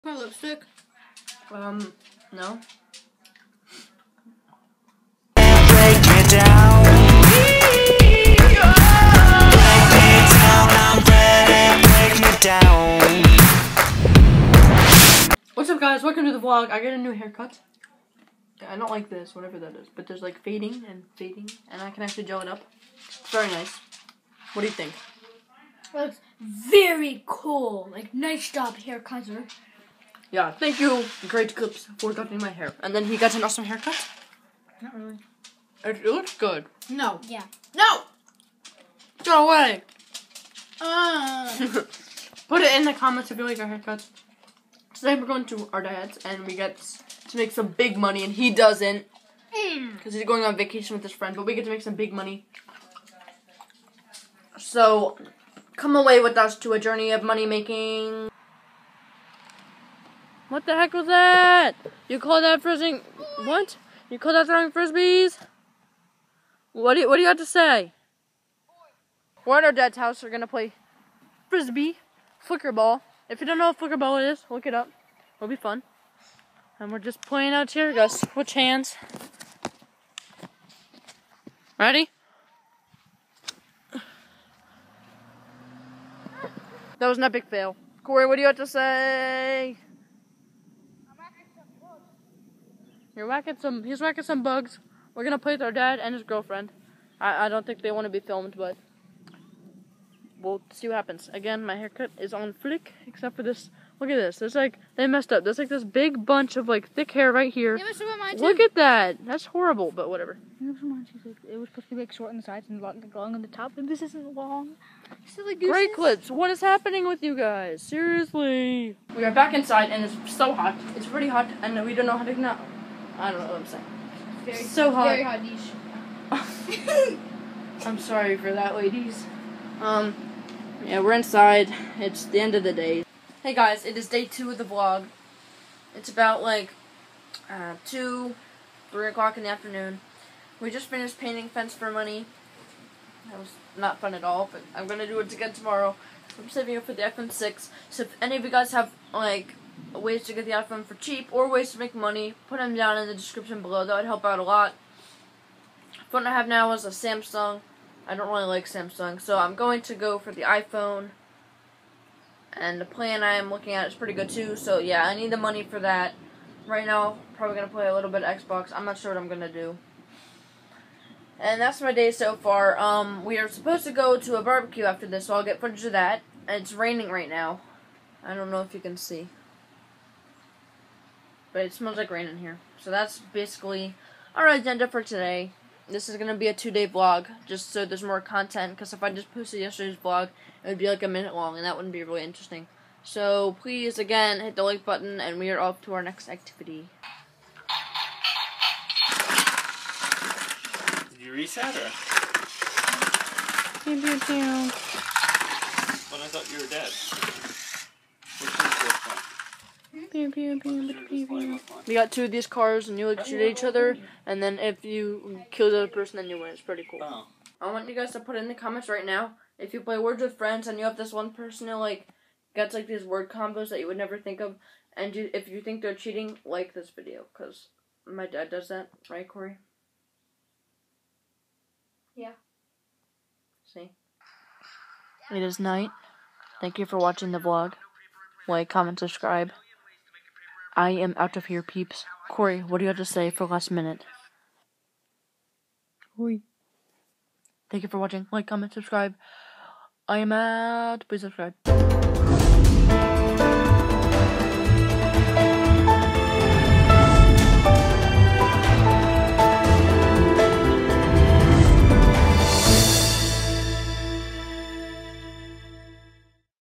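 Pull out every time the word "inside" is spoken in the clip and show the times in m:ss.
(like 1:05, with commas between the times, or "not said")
1:59, 2:11.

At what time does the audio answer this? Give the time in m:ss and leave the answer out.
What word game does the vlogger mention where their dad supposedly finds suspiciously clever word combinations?
3:39.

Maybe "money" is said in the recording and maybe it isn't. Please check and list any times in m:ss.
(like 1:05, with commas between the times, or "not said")
0:47, 0:52, 0:57, 2:21, 2:31, 2:45.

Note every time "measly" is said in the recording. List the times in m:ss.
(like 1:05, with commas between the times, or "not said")
not said.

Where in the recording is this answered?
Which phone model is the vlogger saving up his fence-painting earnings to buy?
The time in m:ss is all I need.
2:27.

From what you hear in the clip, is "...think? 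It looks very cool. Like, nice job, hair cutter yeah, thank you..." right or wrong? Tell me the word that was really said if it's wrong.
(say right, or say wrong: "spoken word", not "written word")
right.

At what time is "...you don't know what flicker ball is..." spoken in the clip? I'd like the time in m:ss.
1:13.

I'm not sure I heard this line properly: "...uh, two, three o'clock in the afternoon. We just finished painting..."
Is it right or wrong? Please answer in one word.
right.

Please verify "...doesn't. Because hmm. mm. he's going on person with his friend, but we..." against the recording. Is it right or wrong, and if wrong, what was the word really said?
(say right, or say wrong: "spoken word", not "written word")
wrong: "vacation", not "person".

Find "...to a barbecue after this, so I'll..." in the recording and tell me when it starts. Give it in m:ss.
2:54.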